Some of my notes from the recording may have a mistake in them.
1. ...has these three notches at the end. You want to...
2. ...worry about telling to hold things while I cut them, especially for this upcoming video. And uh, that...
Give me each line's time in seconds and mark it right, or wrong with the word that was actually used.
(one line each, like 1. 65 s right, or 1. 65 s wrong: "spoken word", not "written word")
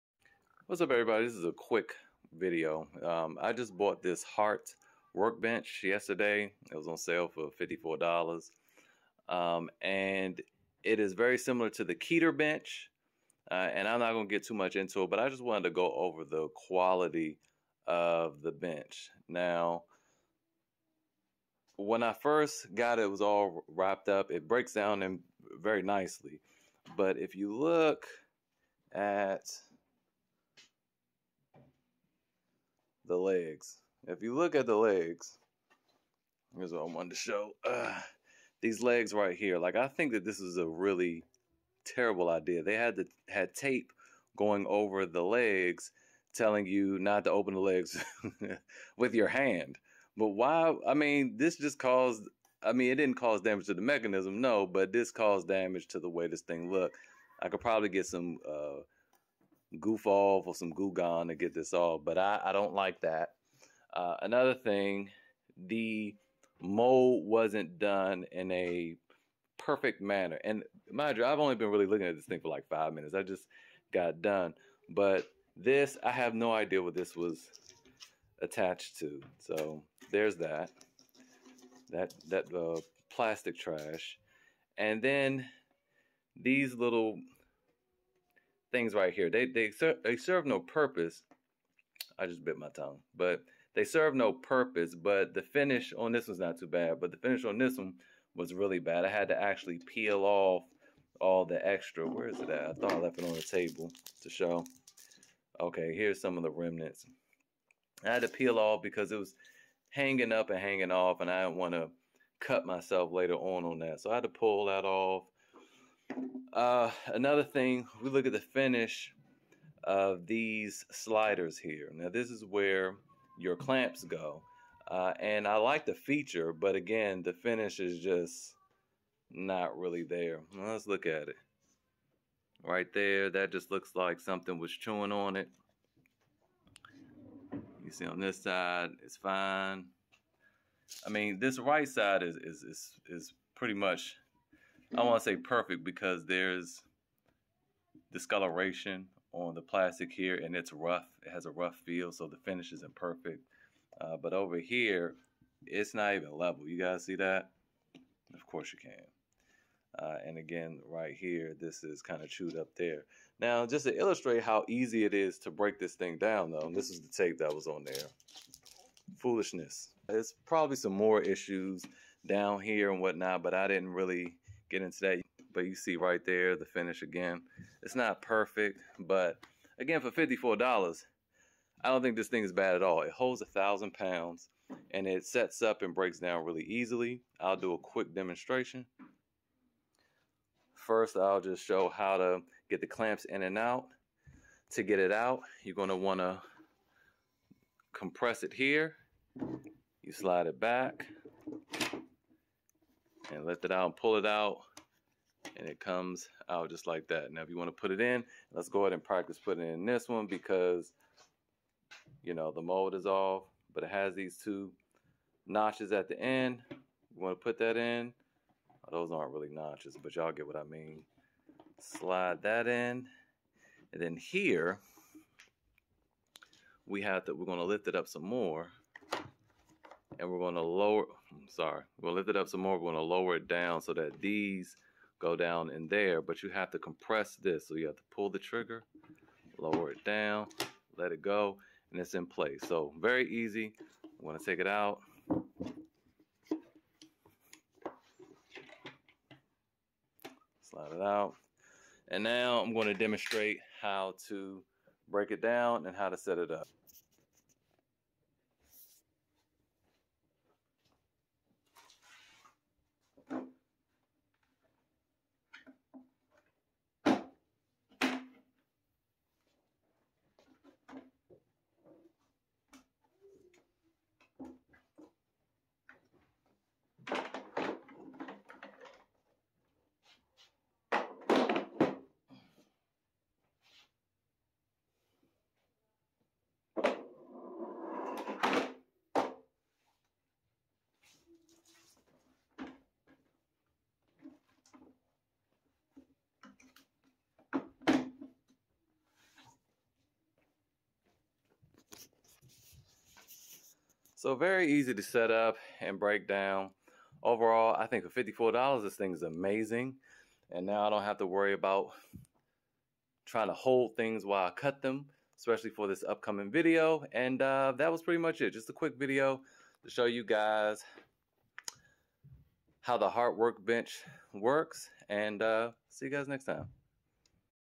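1. 213 s wrong: "two", not "three"
2. 311 s wrong: "trying", not "telling".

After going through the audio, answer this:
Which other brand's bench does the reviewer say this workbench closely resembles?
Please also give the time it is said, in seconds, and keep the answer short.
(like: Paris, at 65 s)
Keter, at 11 s.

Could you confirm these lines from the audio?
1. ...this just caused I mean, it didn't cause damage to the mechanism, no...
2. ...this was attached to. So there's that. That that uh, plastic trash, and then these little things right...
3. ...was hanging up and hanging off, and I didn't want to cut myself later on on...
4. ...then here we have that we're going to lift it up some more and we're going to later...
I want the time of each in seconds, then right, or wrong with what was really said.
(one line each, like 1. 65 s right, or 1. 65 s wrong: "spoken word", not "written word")
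1. 51 s right
2. 76 s right
3. 109 s right
4. 224 s wrong: "lower", not "later".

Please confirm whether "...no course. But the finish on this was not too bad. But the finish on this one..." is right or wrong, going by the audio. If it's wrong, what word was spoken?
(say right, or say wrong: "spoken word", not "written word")
wrong: "purpose", not "course".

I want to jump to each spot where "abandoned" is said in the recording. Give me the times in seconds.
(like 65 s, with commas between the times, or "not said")
not said.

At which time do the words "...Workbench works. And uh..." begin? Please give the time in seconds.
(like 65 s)
323 s.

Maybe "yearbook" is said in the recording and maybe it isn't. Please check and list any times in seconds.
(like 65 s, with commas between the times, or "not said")
not said.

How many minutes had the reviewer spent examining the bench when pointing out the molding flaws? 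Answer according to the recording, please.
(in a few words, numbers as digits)
5.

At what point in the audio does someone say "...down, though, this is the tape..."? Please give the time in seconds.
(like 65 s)
166 s.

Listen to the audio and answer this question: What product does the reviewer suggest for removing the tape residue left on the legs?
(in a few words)
Goof Off.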